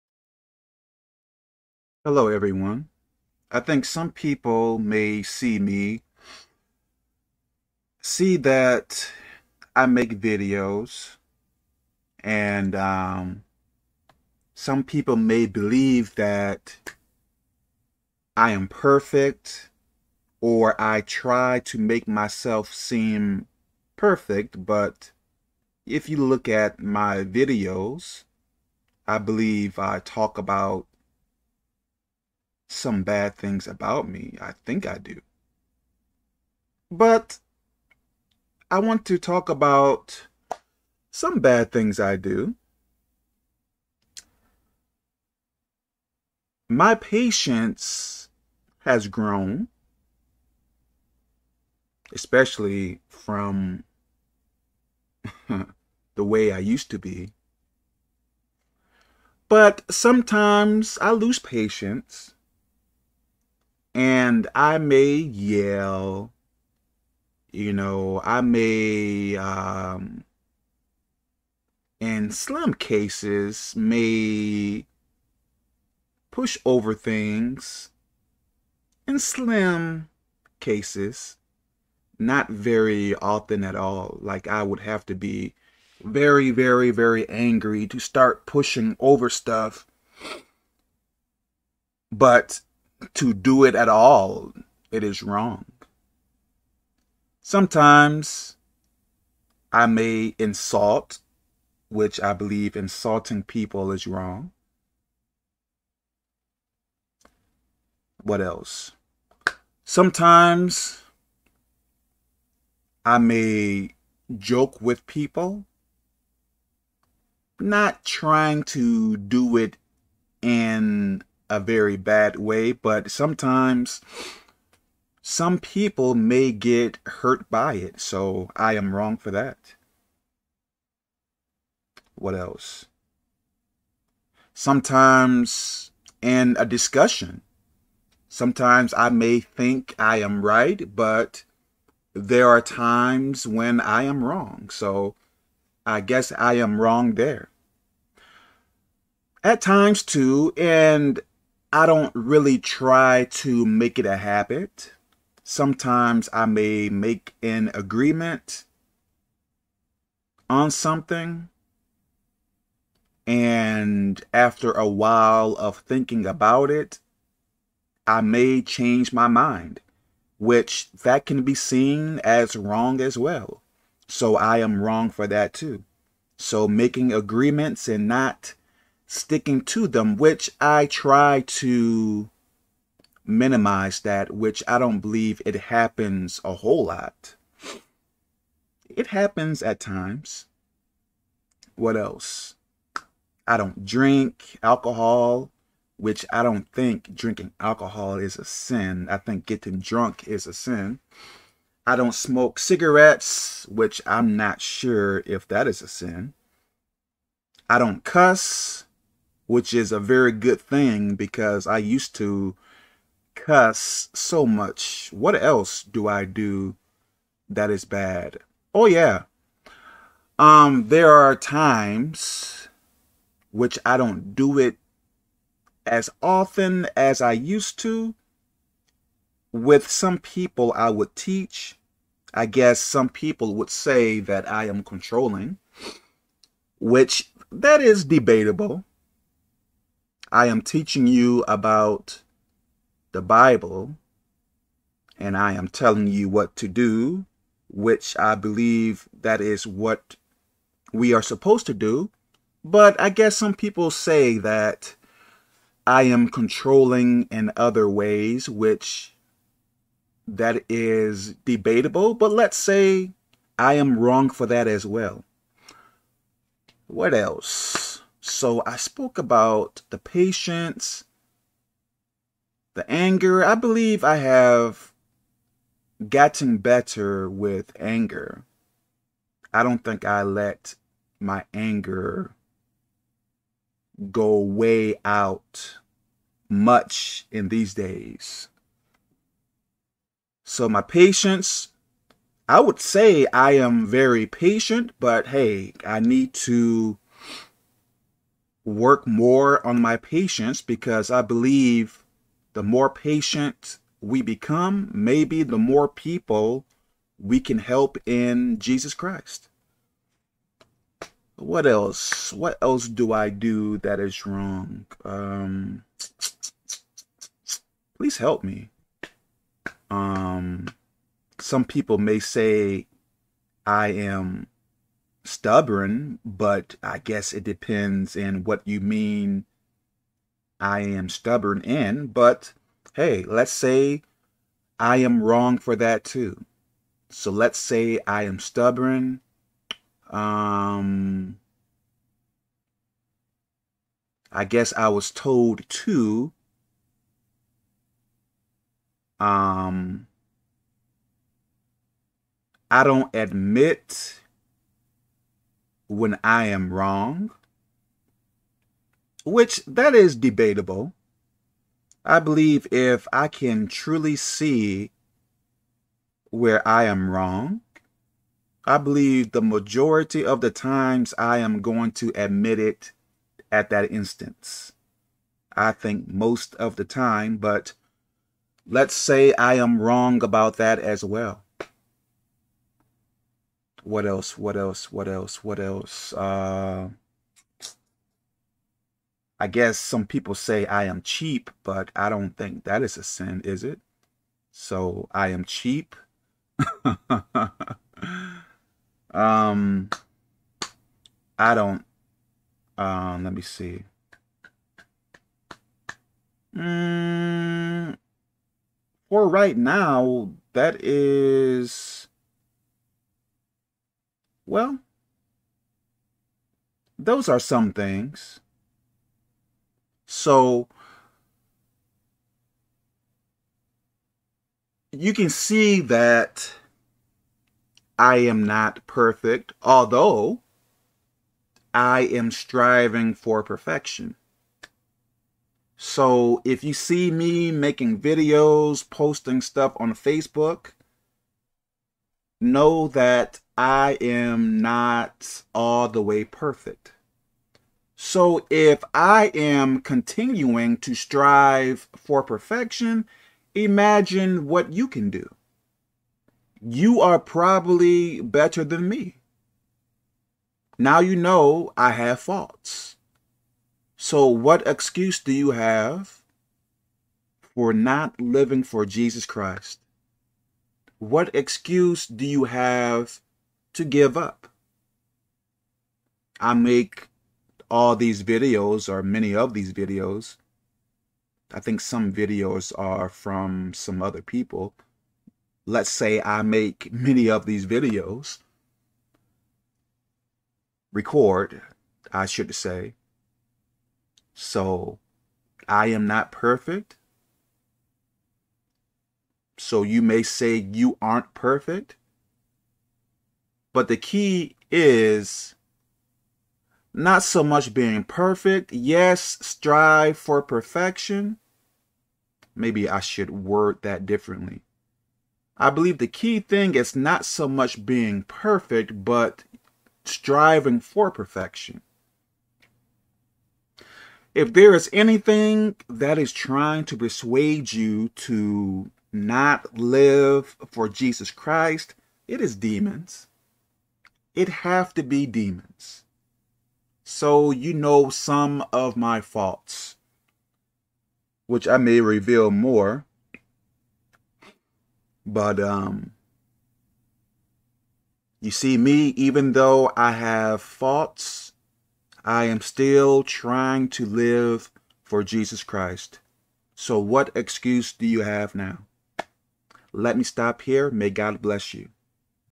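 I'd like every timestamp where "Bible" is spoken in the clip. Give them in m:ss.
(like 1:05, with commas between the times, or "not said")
4:03.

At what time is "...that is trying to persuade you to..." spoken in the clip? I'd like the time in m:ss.
8:45.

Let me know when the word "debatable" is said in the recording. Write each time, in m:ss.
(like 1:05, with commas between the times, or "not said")
3:58, 4:21, 6:00.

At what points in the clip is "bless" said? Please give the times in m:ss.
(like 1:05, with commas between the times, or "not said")
9:21.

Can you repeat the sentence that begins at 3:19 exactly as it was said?
I think getting drunk is a sin.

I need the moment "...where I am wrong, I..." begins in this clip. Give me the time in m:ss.
6:06.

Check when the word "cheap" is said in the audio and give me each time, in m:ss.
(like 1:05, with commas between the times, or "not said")
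6:31, 6:35.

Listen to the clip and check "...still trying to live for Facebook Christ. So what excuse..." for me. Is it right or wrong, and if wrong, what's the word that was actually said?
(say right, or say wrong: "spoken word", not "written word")
wrong: "Jesus", not "Facebook".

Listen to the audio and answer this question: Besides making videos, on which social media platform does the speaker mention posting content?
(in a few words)
Facebook.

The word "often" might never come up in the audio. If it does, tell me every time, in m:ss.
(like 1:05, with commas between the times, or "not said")
1:23, 3:46.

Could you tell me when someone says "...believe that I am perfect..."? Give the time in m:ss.
0:15.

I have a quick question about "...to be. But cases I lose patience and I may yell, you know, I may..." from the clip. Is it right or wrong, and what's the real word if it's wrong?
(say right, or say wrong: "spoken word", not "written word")
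wrong: "sometimes", not "cases".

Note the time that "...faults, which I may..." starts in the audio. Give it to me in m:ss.
8:59.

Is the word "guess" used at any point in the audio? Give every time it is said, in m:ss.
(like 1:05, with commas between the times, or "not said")
2:25, 3:52, 4:13, 5:26, 5:44, 6:29.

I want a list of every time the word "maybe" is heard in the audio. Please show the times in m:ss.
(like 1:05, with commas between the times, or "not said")
5:04, 8:32.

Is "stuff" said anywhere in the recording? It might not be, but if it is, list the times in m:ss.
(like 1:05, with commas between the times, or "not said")
1:29, 7:19.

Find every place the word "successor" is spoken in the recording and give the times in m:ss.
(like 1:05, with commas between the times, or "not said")
not said.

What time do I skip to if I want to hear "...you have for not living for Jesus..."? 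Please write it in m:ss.
7:45.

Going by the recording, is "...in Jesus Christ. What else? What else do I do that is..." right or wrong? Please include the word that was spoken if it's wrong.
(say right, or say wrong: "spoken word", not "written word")
right.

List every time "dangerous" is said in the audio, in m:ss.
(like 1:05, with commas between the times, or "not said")
not said.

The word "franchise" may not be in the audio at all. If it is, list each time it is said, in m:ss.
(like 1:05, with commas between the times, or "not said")
not said.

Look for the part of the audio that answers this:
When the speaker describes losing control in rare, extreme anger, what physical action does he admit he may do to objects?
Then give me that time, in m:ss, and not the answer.
1:16.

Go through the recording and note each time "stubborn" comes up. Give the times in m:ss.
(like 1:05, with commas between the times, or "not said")
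5:25, 5:31, 5:38.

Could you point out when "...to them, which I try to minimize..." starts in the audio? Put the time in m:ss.
2:59.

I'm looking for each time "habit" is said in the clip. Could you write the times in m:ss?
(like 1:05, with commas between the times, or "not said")
2:34.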